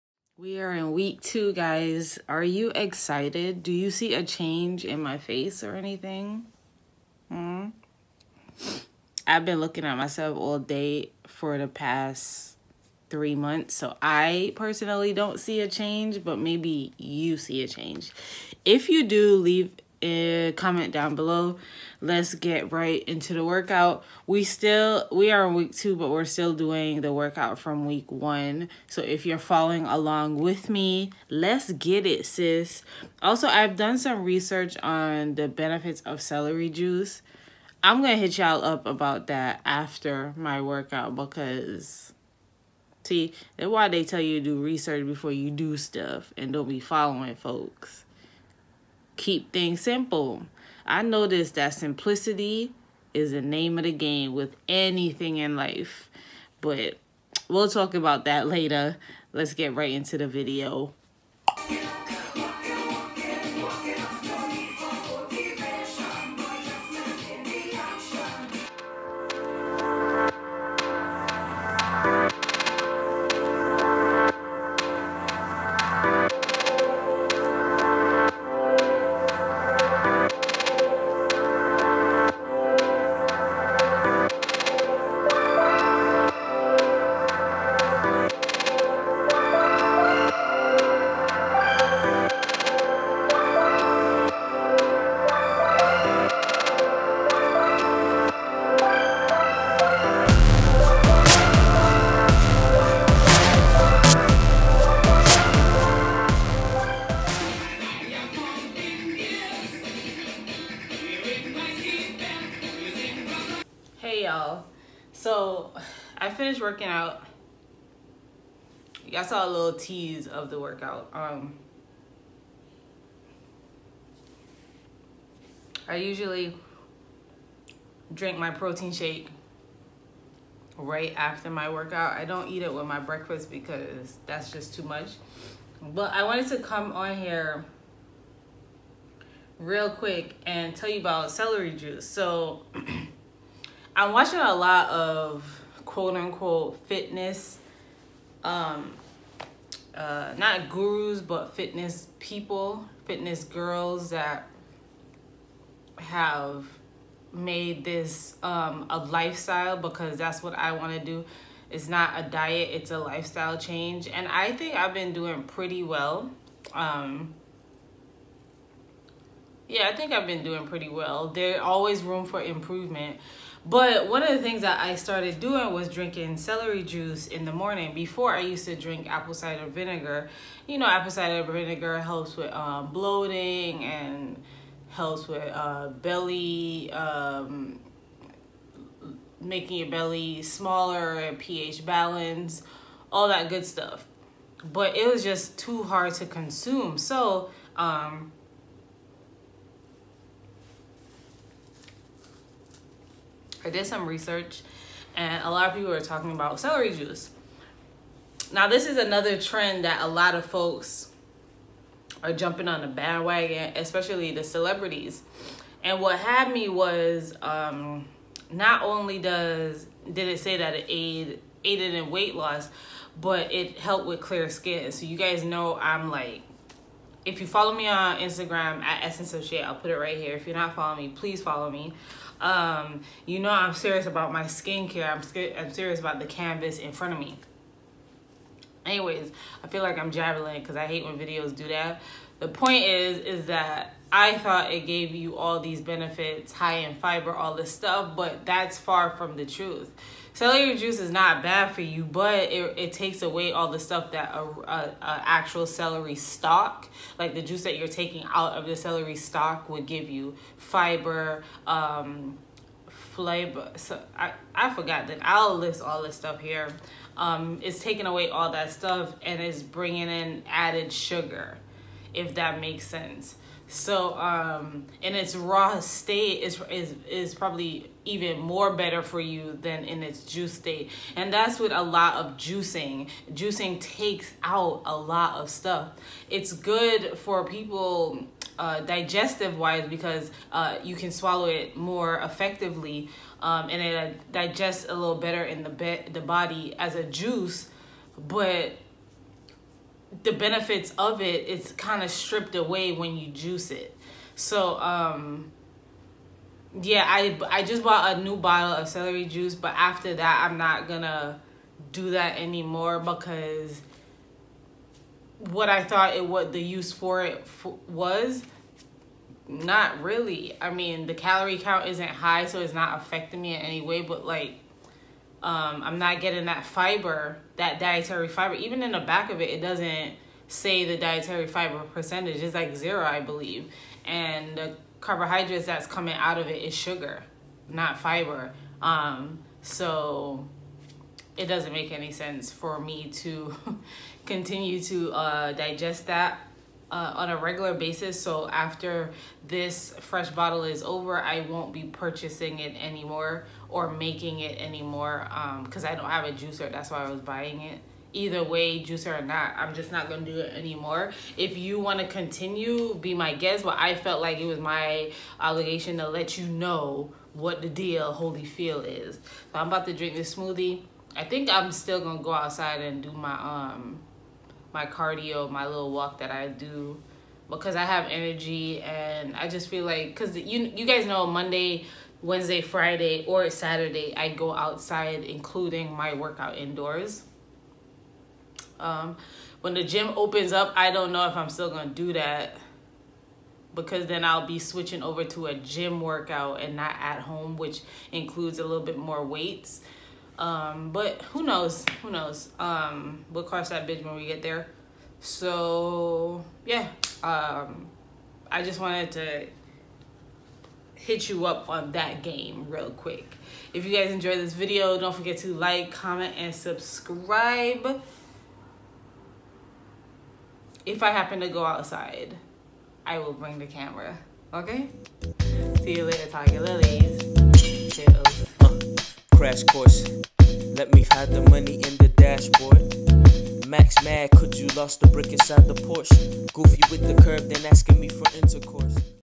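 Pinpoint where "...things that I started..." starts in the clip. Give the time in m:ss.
2:54.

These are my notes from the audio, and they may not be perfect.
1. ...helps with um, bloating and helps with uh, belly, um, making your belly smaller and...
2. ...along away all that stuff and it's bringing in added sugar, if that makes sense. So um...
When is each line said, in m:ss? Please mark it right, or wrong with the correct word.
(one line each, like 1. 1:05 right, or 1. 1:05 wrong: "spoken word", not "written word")
1. 3:01 right
2. 4:27 wrong: "taking", not "along".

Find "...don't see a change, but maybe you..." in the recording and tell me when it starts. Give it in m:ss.
0:15.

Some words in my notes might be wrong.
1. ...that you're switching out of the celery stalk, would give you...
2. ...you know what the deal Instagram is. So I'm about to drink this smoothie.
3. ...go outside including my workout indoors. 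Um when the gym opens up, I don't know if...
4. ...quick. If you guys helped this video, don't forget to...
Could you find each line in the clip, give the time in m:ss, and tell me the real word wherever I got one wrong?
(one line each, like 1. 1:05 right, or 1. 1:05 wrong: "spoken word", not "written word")
1. 4:17 wrong: "taking", not "switching"
2. 6:06 wrong: "Holyfield", not "Instagram"
3. 6:24 right
4. 6:52 wrong: "enjoyed", not "helped".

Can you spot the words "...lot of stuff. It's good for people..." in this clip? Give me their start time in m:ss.
4:44.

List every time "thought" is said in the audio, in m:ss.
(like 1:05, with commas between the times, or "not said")
4:04, 5:15.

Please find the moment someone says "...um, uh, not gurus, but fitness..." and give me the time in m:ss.
2:28.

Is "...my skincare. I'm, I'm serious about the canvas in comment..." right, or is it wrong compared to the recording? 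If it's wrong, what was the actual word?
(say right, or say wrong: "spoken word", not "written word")
wrong: "front", not "comment".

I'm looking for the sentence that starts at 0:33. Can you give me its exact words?
Also, I've done some research on the benefits of celery juice.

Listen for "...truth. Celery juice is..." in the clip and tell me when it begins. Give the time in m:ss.
4:09.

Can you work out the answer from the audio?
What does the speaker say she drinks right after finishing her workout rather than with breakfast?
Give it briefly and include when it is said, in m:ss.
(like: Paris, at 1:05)
Protein shake, at 2:08.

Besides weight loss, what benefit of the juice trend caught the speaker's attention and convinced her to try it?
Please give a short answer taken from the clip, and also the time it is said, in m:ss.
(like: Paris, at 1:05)
Clear skin, at 3:44.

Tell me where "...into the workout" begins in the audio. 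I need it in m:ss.
0:23.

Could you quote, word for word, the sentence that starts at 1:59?
Y'all saw a little tease of the workout.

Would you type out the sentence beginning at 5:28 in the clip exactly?
Even in the back of it, it doesn't say the dietary fiber percentage.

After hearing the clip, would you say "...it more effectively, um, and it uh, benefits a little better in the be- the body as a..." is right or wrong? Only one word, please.
wrong.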